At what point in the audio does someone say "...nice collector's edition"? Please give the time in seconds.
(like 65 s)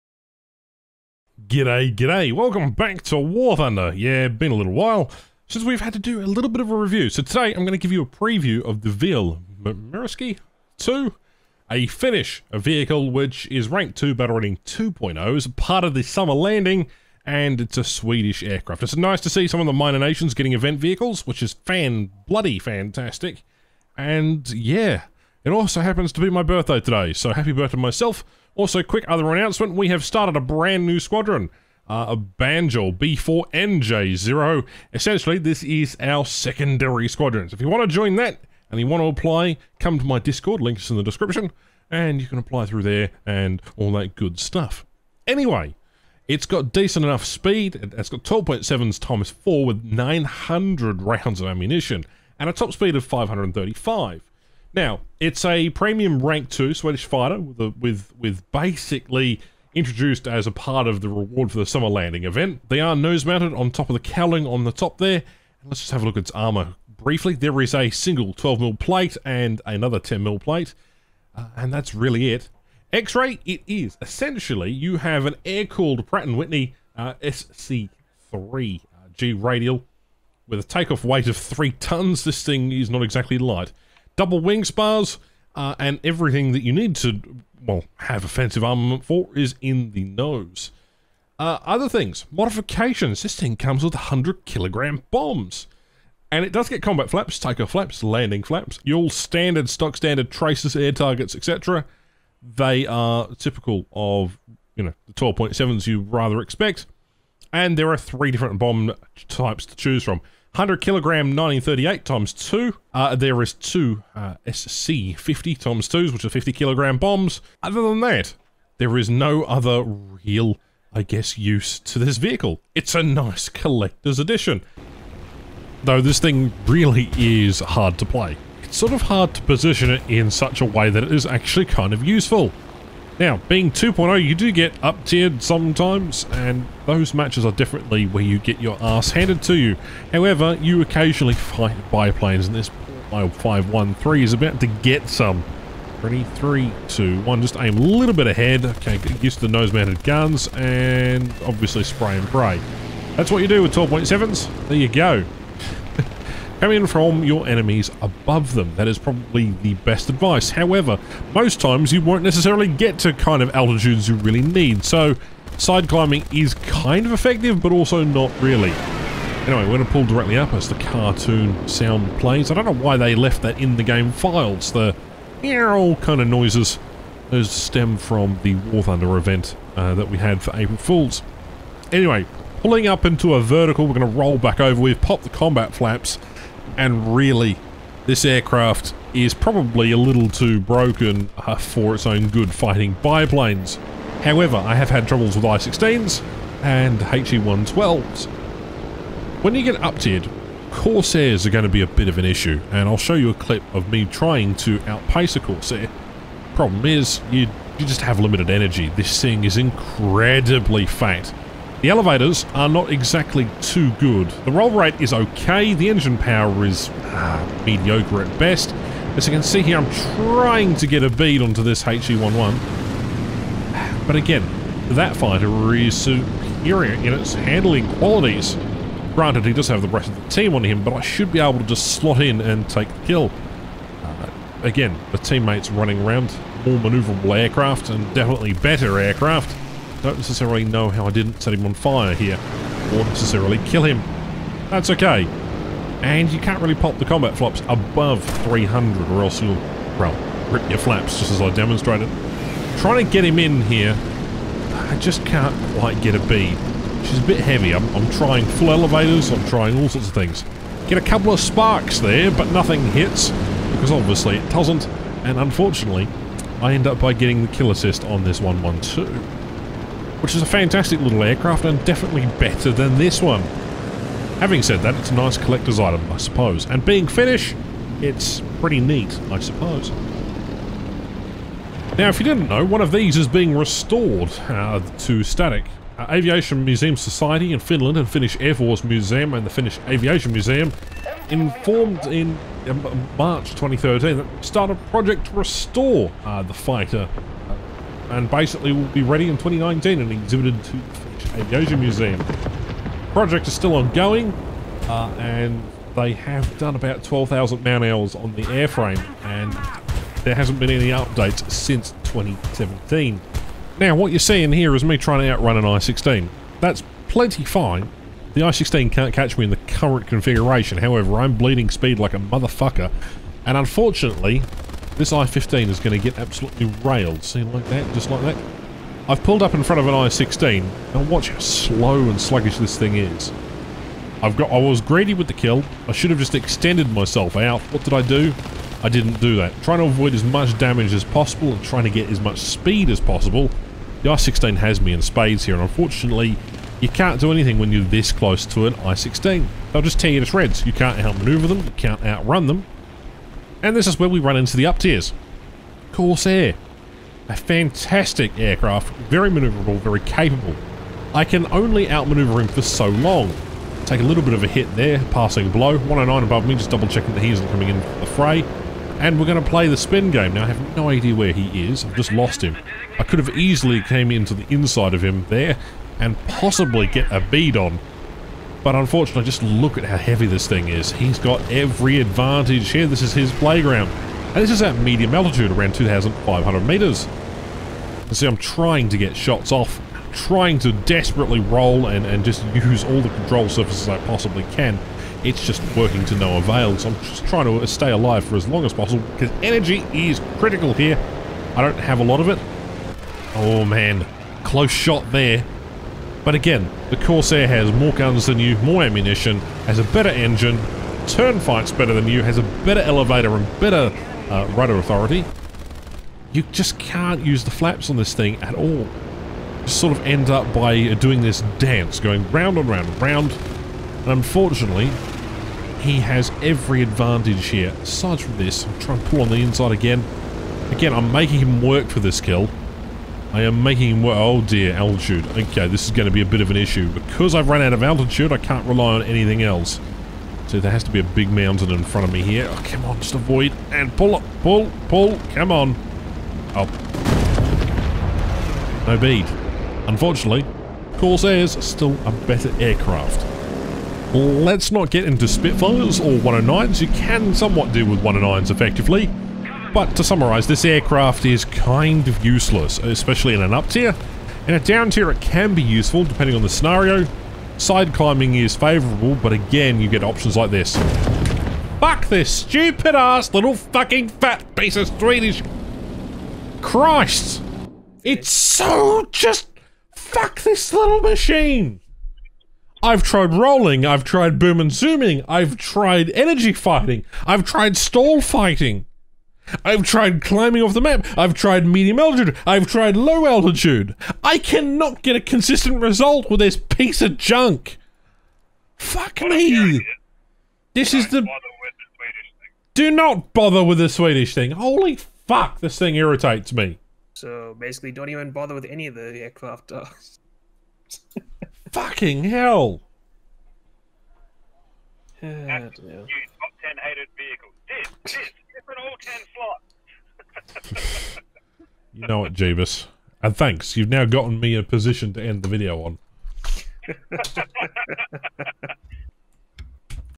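123 s.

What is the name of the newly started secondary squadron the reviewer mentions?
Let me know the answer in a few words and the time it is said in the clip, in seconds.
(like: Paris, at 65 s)
B4NJ0, at 32 s.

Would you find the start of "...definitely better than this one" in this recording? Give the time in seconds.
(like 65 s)
271 s.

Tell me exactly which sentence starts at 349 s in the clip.
They'll just tear you to shreds.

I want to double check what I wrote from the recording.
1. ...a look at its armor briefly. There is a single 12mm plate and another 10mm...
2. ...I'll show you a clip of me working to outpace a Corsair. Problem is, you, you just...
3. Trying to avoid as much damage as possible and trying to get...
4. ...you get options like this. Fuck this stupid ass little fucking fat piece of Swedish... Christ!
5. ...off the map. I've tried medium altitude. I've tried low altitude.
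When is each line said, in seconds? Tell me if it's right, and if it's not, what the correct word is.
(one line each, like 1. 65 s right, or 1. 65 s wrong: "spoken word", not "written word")
1. 66 s right
2. 202 s wrong: "trying", not "working"
3. 339 s right
4. 469 s right
5. 490 s right.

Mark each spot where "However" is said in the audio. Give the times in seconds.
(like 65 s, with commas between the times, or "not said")
140 s, 160 s, 194 s, 320 s.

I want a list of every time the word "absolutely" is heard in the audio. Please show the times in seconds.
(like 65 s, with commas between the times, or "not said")
326 s.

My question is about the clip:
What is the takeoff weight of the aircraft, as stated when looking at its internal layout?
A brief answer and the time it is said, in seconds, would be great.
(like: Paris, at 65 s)
3 tons, at 81 s.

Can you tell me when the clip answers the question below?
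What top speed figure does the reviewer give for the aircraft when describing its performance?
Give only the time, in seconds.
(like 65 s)
53 s.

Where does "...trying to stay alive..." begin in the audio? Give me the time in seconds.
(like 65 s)
397 s.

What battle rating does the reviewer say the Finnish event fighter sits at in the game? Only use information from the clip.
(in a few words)
2.0.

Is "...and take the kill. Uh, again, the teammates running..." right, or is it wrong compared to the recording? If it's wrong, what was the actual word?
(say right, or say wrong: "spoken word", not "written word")
right.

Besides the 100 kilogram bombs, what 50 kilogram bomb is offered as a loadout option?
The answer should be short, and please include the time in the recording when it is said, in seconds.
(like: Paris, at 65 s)
SC-50, at 114 s.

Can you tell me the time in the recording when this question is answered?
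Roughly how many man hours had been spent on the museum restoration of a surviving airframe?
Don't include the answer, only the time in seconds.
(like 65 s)
307 s.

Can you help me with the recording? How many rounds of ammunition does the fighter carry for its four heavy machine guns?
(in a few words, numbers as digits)
900.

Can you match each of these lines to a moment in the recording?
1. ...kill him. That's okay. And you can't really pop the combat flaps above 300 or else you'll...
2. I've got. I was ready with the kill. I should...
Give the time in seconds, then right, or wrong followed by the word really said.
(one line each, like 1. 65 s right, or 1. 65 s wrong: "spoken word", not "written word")
1. 243 s right
2. 334 s wrong: "greedy", not "ready".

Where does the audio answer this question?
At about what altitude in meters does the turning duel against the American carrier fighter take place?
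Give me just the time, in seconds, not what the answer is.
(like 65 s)
385 s.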